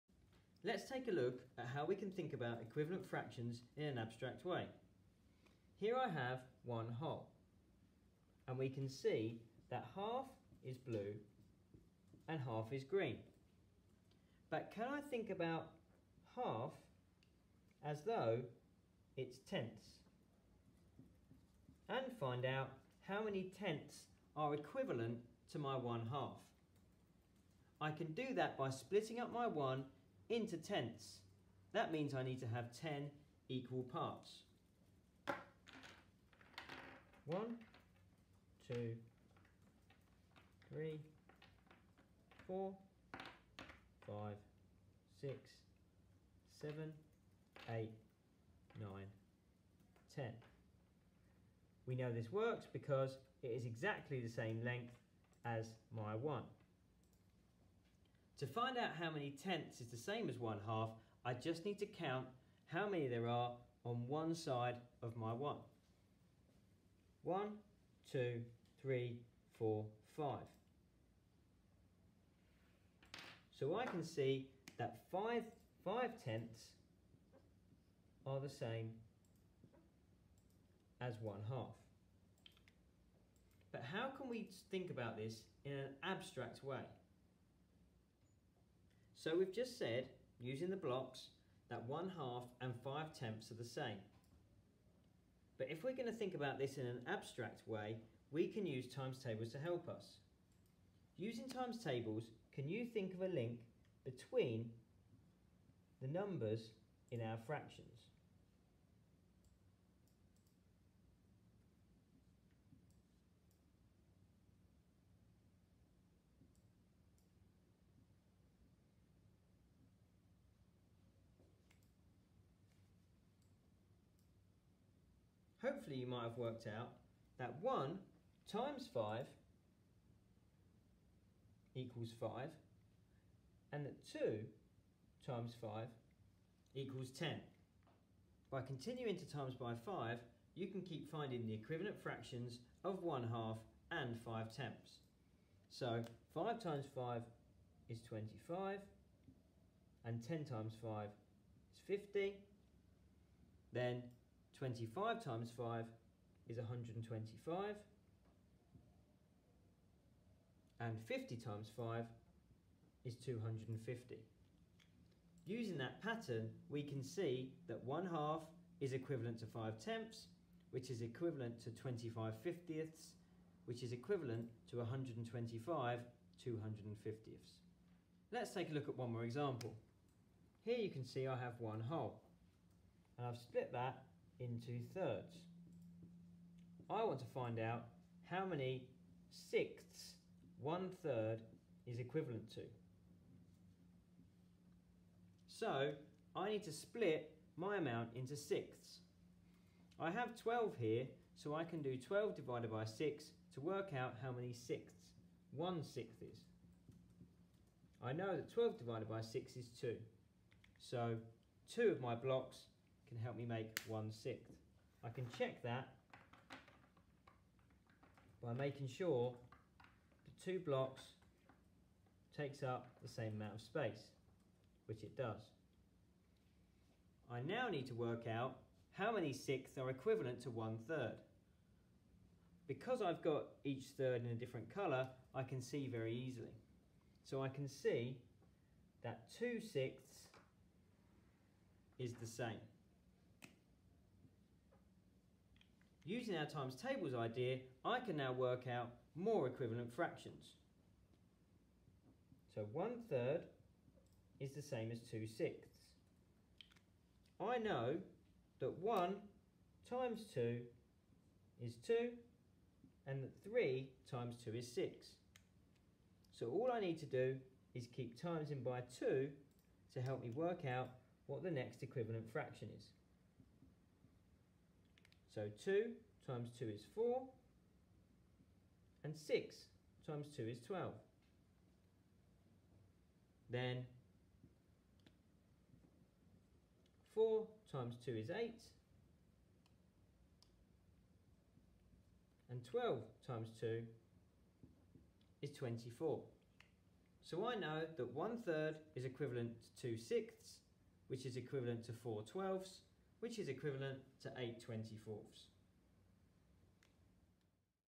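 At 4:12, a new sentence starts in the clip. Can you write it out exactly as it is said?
So 1 third is the same as 2 sixths.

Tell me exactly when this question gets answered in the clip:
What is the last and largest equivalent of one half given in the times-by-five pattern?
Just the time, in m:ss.
2:54.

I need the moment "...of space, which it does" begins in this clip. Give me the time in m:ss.
3:43.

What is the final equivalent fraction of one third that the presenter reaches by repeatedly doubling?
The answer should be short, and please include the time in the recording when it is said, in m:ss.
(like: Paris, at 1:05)
8 24ths, at 5:04.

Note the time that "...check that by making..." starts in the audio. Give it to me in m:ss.
3:35.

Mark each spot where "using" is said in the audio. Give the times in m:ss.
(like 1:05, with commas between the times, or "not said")
1:30, 1:41, 2:45, 4:06.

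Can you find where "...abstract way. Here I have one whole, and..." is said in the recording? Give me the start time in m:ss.
0:03.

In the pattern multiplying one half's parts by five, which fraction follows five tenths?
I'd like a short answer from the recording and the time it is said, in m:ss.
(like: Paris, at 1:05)
25 fiftieths, at 2:51.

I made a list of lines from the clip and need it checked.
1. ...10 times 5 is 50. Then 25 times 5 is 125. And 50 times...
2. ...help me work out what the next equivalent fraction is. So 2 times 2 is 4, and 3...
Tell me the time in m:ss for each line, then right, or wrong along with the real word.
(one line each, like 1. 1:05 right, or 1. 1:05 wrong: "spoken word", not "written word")
1. 2:30 right
2. 4:30 wrong: "6", not "3".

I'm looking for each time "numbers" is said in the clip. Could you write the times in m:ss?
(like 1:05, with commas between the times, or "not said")
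1:46.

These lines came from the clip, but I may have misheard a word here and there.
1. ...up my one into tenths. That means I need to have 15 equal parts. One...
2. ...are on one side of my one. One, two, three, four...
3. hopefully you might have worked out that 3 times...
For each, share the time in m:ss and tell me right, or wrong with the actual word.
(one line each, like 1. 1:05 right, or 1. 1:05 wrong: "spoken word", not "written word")
1. 0:29 wrong: "10", not "15"
2. 1:03 right
3. 2:05 wrong: "1", not "3".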